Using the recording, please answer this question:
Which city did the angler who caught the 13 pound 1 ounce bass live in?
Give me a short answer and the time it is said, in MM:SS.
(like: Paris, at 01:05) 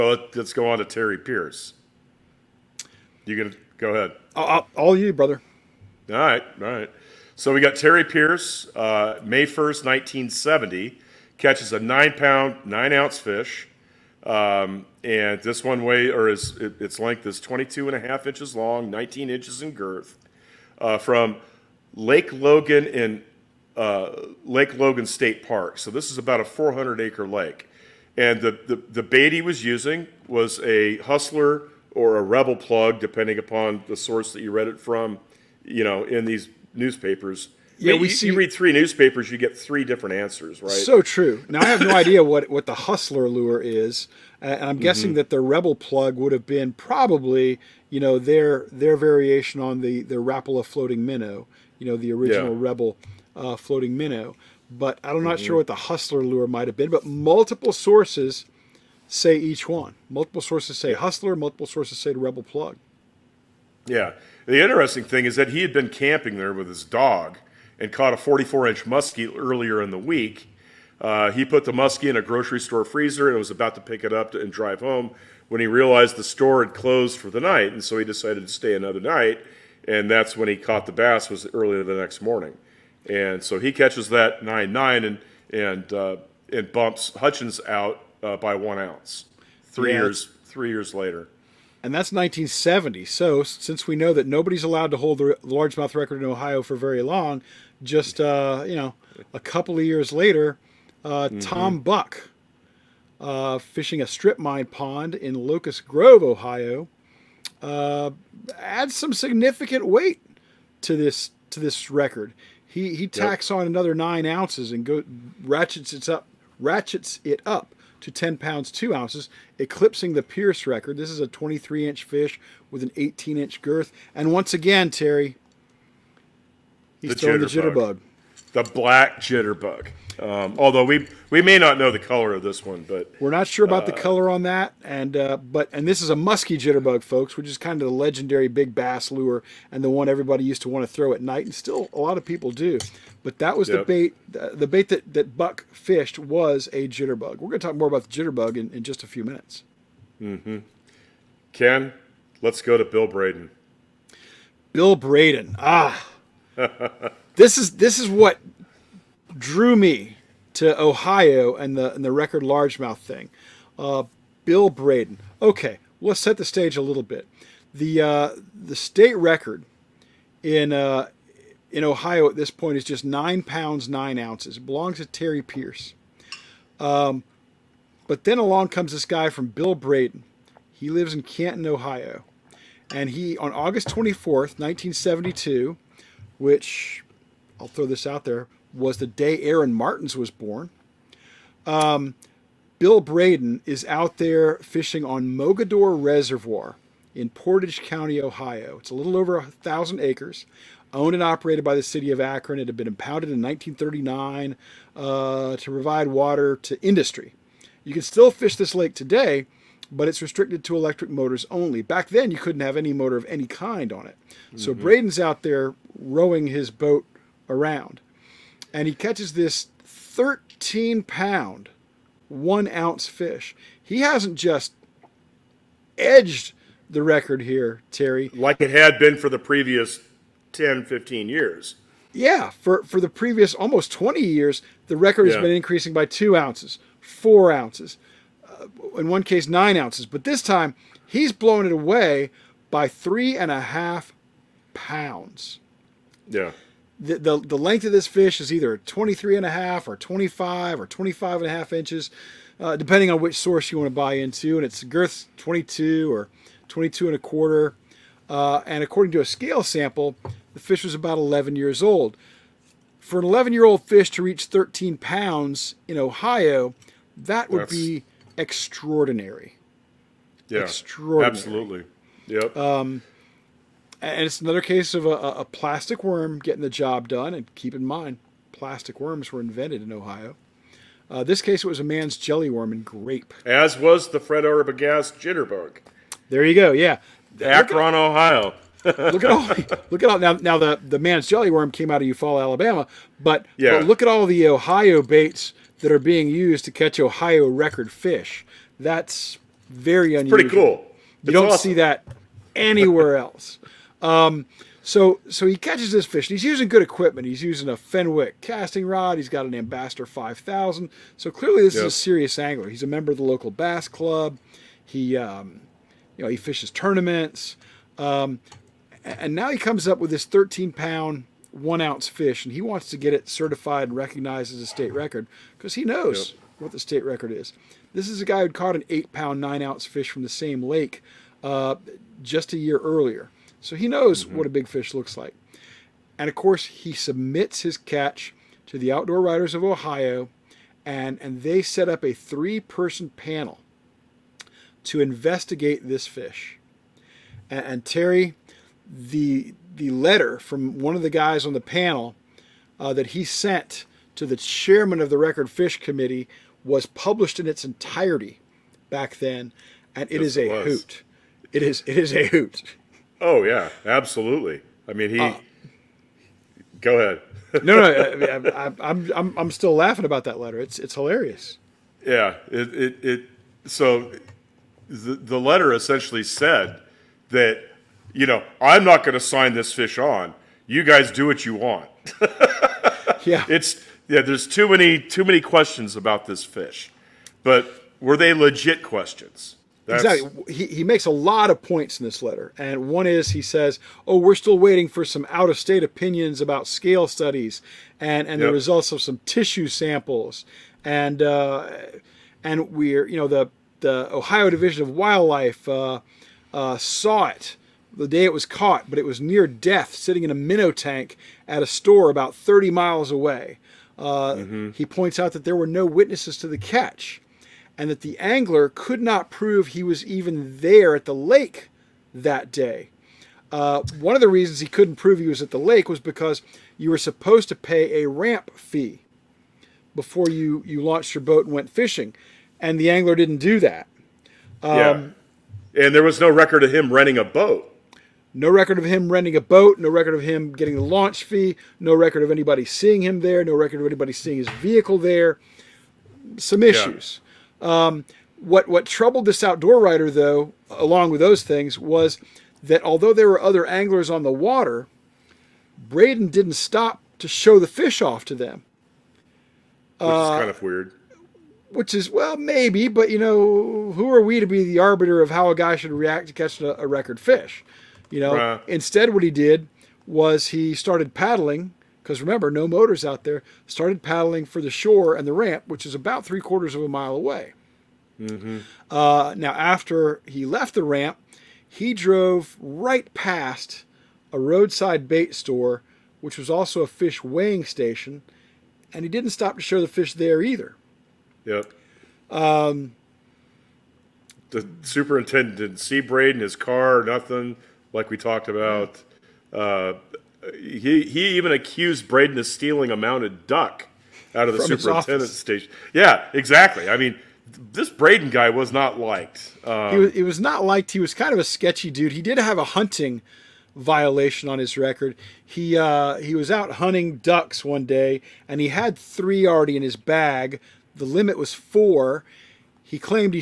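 Canton, at 03:01.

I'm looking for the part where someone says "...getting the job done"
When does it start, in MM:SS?
04:36.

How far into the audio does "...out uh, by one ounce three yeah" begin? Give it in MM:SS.
01:27.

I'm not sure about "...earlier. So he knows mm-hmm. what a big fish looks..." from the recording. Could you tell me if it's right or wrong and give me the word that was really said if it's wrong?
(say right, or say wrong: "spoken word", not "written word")
right.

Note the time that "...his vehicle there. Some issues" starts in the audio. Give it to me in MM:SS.
07:24.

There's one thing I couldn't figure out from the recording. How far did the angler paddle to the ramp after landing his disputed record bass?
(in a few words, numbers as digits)
three quarters of a mile.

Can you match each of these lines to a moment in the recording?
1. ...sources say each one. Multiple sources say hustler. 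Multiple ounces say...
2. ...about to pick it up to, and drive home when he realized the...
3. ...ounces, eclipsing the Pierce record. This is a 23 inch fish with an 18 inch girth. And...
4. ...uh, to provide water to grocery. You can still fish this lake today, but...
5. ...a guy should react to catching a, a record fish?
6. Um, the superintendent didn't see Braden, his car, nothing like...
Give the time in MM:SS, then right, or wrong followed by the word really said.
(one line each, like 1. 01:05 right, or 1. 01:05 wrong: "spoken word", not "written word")
1. 00:57 wrong: "sources", not "ounces"
2. 01:13 right
3. 01:58 right
4. 03:24 wrong: "industry", not "grocery"
5. 07:45 right
6. 08:12 right.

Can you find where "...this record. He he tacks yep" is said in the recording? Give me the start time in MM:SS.
01:51.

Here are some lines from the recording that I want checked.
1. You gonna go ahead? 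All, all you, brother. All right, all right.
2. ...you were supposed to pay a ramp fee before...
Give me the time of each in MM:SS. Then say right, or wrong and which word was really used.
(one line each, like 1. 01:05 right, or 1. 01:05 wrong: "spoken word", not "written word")
1. 00:03 right
2. 07:06 right.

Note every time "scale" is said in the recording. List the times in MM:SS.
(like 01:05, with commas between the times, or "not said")
04:19, 06:36.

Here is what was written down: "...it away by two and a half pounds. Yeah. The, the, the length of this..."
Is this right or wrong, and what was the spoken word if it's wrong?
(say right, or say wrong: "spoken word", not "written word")
wrong: "three", not "two".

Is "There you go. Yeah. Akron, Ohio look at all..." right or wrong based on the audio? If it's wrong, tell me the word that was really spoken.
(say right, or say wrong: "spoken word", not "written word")
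right.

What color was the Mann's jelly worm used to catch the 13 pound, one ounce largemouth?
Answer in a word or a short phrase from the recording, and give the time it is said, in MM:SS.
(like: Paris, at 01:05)
grape, at 04:42.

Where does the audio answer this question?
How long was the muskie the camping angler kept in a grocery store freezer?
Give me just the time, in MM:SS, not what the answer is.
01:08.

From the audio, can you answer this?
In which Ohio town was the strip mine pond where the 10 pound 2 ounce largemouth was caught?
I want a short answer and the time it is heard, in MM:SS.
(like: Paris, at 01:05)
Locust Grove, at 01:45.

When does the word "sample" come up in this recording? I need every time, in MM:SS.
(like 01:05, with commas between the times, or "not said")
04:19, 06:39.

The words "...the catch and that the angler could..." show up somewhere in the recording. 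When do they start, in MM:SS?
06:56.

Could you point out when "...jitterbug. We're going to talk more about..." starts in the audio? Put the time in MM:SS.
02:26.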